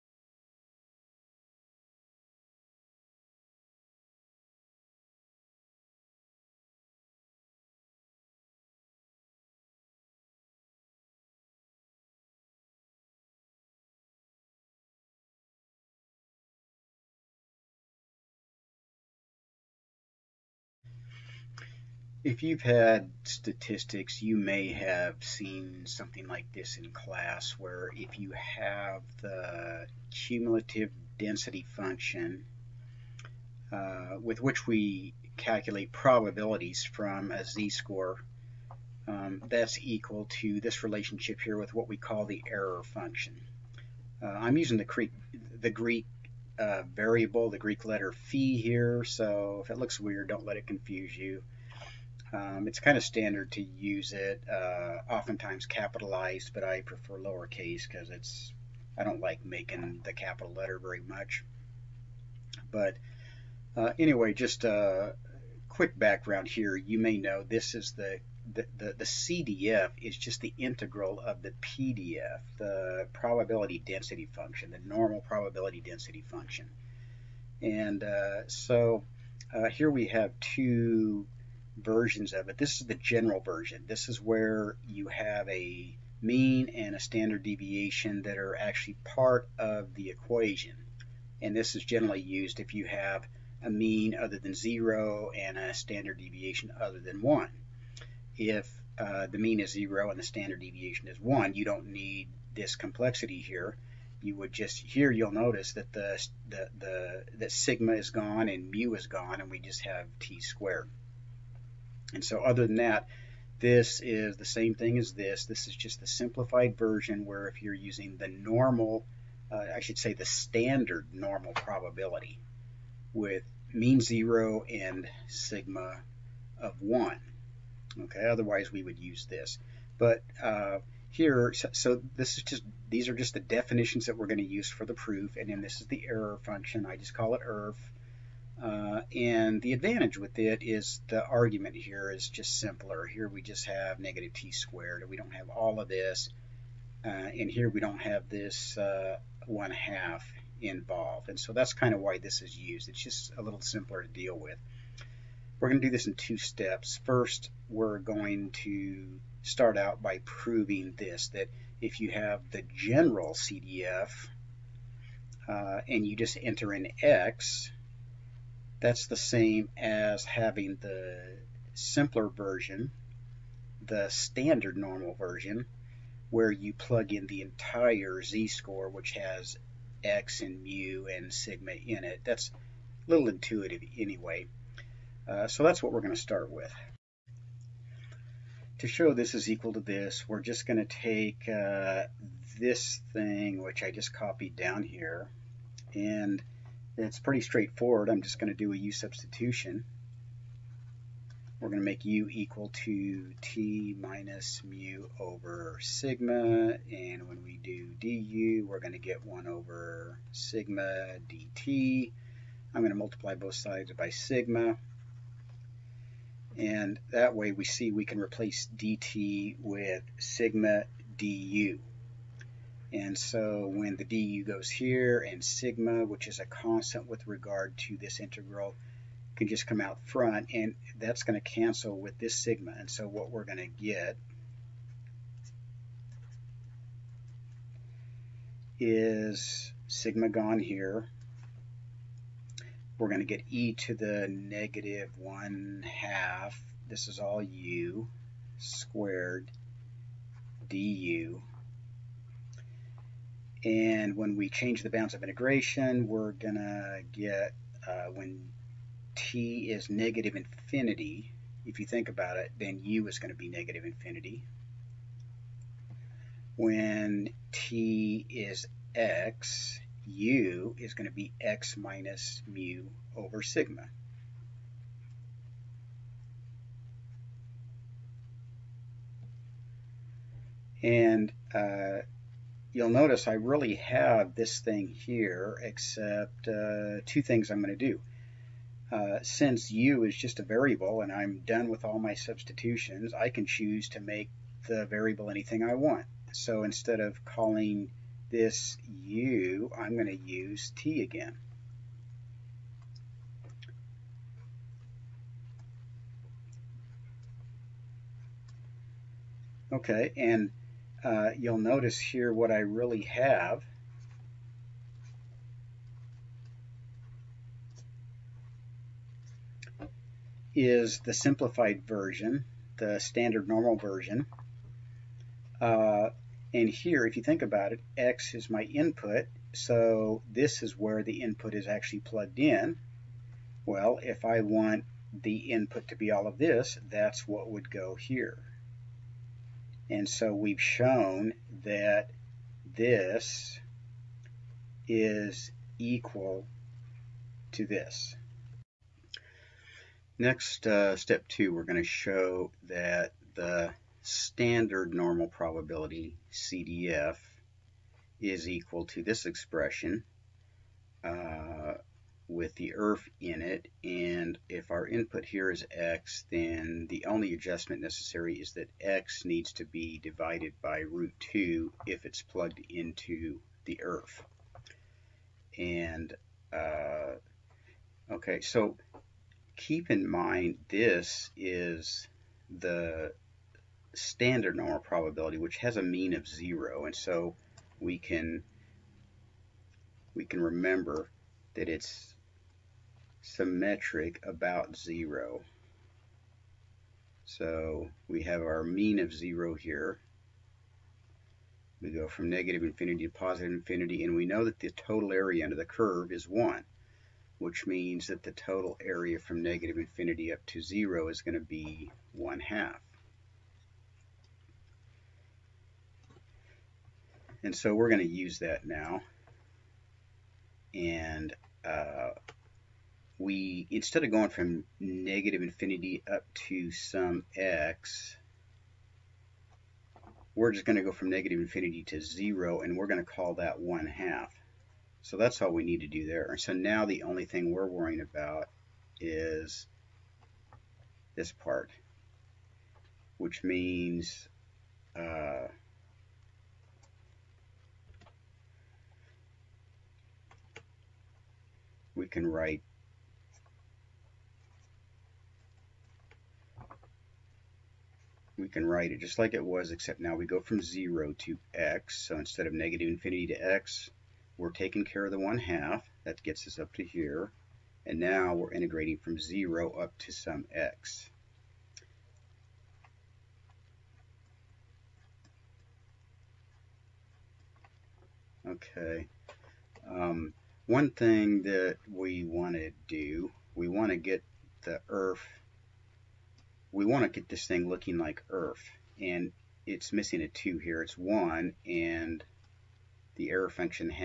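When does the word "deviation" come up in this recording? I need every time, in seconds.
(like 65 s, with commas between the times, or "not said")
87 s, 96 s, 100 s.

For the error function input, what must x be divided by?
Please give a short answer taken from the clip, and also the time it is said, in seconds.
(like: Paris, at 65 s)
root 2, at 370 s.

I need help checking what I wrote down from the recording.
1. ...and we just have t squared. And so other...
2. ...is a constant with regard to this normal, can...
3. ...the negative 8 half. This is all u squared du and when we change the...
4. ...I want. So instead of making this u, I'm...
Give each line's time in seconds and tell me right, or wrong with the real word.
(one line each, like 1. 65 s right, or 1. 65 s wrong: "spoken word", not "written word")
1. 109 s right
2. 226 s wrong: "integral", not "normal"
3. 243 s wrong: "1", not "8"
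4. 295 s wrong: "calling", not "making".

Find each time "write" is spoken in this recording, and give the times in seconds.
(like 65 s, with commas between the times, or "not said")
452 s, 458 s.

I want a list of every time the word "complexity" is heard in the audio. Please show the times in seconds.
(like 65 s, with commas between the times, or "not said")
102 s.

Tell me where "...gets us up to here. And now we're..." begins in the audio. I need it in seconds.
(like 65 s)
466 s.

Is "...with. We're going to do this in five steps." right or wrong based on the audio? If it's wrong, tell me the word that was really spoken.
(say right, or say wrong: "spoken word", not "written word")
wrong: "two", not "five".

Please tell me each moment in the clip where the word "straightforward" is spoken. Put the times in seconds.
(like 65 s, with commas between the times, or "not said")
197 s.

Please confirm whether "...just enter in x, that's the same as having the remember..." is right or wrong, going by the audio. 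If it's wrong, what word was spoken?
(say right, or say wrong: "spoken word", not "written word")
wrong: "simpler", not "remember".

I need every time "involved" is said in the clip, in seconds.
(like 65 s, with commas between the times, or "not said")
150 s.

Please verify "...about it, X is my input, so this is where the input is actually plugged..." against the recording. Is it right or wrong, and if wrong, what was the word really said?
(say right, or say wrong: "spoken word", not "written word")
right.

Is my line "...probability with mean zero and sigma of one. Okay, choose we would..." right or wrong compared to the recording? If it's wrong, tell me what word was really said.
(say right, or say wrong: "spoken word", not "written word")
wrong: "otherwise", not "choose".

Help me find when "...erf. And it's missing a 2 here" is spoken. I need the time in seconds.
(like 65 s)
488 s.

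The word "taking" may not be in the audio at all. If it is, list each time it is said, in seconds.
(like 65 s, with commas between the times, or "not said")
464 s.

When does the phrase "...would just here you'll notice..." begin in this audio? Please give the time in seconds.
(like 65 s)
104 s.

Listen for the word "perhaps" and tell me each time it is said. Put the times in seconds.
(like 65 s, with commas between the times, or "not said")
not said.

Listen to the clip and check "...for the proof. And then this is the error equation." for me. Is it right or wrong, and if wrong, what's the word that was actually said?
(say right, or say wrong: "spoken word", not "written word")
wrong: "function", not "equation".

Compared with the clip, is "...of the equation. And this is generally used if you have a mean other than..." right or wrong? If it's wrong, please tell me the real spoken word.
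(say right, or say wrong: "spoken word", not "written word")
right.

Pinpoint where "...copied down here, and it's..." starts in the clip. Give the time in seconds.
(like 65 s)
194 s.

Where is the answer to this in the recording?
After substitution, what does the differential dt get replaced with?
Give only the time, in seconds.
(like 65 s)
220 s.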